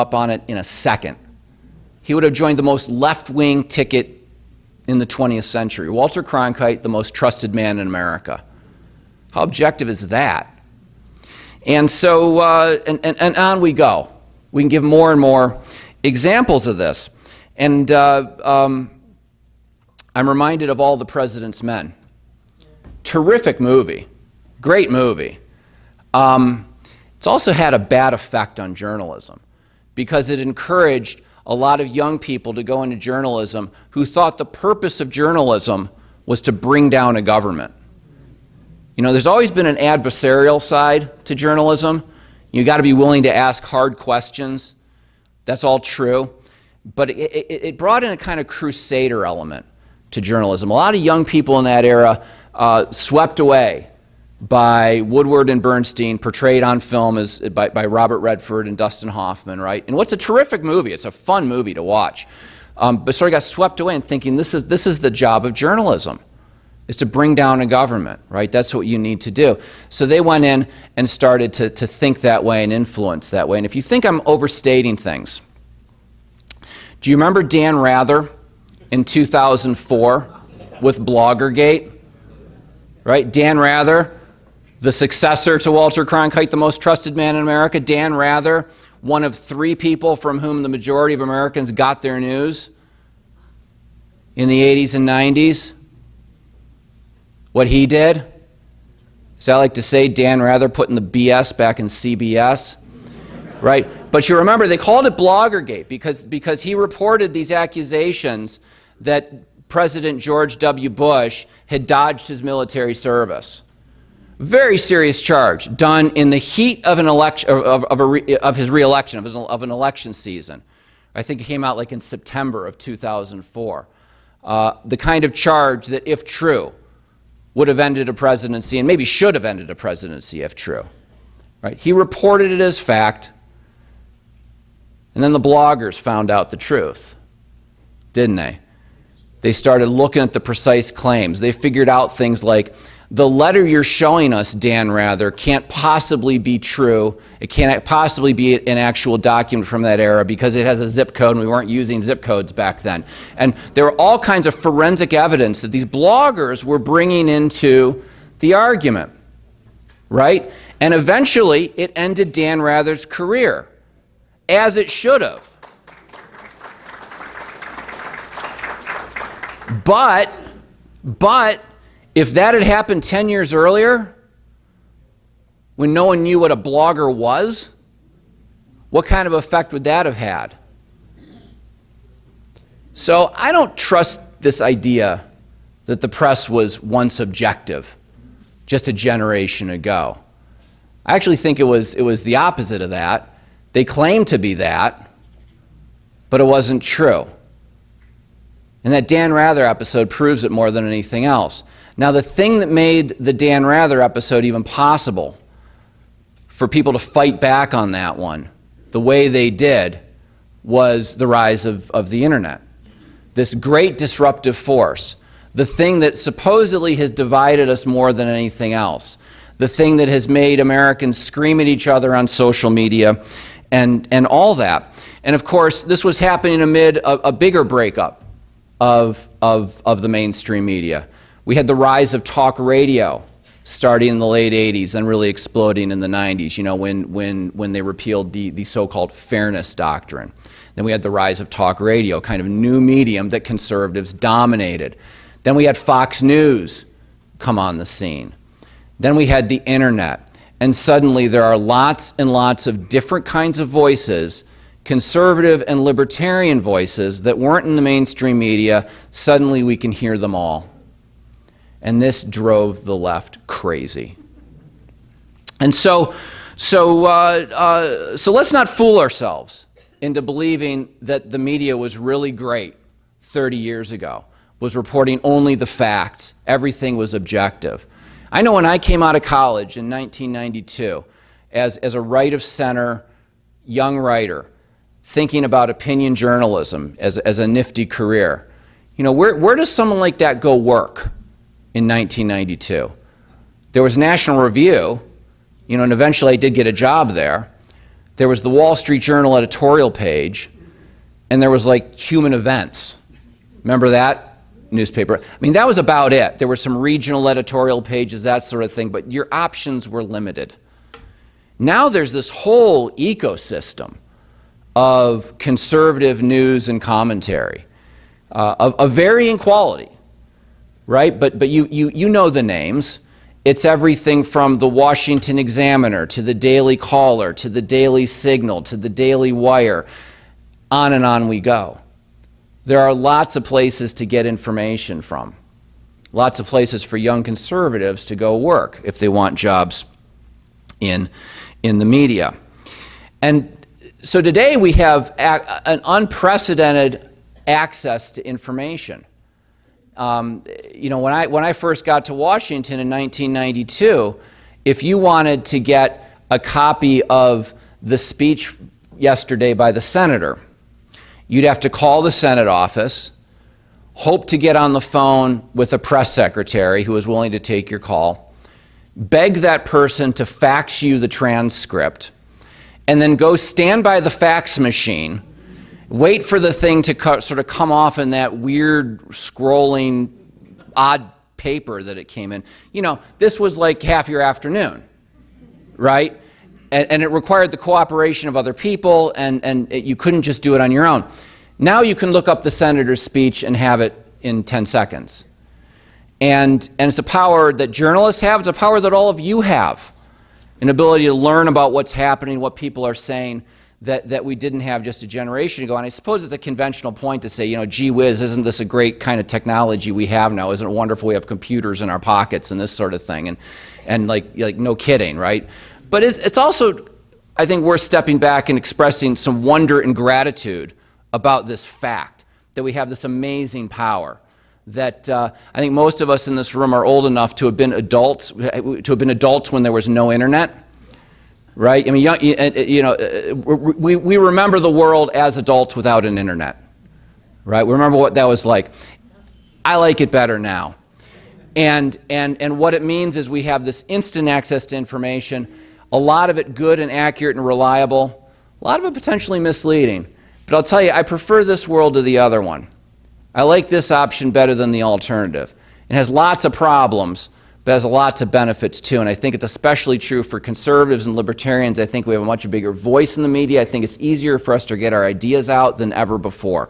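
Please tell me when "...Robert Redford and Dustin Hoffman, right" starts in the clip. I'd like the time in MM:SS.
00:57.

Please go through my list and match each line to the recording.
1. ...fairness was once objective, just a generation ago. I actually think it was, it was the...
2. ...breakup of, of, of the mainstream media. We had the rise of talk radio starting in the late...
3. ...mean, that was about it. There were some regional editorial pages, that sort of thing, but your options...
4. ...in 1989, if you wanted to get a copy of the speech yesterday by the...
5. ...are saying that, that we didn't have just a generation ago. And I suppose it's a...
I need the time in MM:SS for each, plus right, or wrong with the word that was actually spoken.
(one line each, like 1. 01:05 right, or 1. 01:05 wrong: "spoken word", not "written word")
1. 03:06 wrong: "press", not "fairness"
2. 03:47 right
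3. 05:05 right
4. 05:52 wrong: "1992", not "1989"
5. 06:42 right.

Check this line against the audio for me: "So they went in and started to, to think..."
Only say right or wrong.
right.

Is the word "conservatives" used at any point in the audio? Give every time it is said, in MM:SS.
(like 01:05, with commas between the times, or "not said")
04:03, 04:14, 05:15, 05:37, 07:40.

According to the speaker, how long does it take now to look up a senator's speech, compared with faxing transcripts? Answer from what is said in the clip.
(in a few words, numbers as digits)
10 seconds.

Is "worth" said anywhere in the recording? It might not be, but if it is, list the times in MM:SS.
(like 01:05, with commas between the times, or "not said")
06:57.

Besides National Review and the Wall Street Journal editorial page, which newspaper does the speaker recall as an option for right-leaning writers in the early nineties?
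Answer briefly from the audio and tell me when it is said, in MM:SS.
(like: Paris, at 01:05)
Human Events, at 05:01.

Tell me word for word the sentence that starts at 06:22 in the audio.
You know, this was like half your afternoon, right?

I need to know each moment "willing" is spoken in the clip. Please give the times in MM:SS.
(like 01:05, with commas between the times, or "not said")
00:42, 06:07.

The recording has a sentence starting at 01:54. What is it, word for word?
Very serious charge done in the heat of, an election, of, of, re, of his reelection, of, his, of an election season.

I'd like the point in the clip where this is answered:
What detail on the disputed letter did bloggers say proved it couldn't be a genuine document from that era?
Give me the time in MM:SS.
02:30.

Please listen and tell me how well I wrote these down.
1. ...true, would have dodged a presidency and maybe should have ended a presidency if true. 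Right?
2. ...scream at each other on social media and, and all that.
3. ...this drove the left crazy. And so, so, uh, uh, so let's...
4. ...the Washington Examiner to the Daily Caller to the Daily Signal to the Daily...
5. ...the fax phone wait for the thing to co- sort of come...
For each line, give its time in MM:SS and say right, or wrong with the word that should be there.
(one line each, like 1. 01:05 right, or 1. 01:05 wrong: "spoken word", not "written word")
1. 02:06 wrong: "ended", not "dodged"
2. 03:41 right
3. 04:22 right
4. 05:24 right
5. 06:14 wrong: "machine", not "phone".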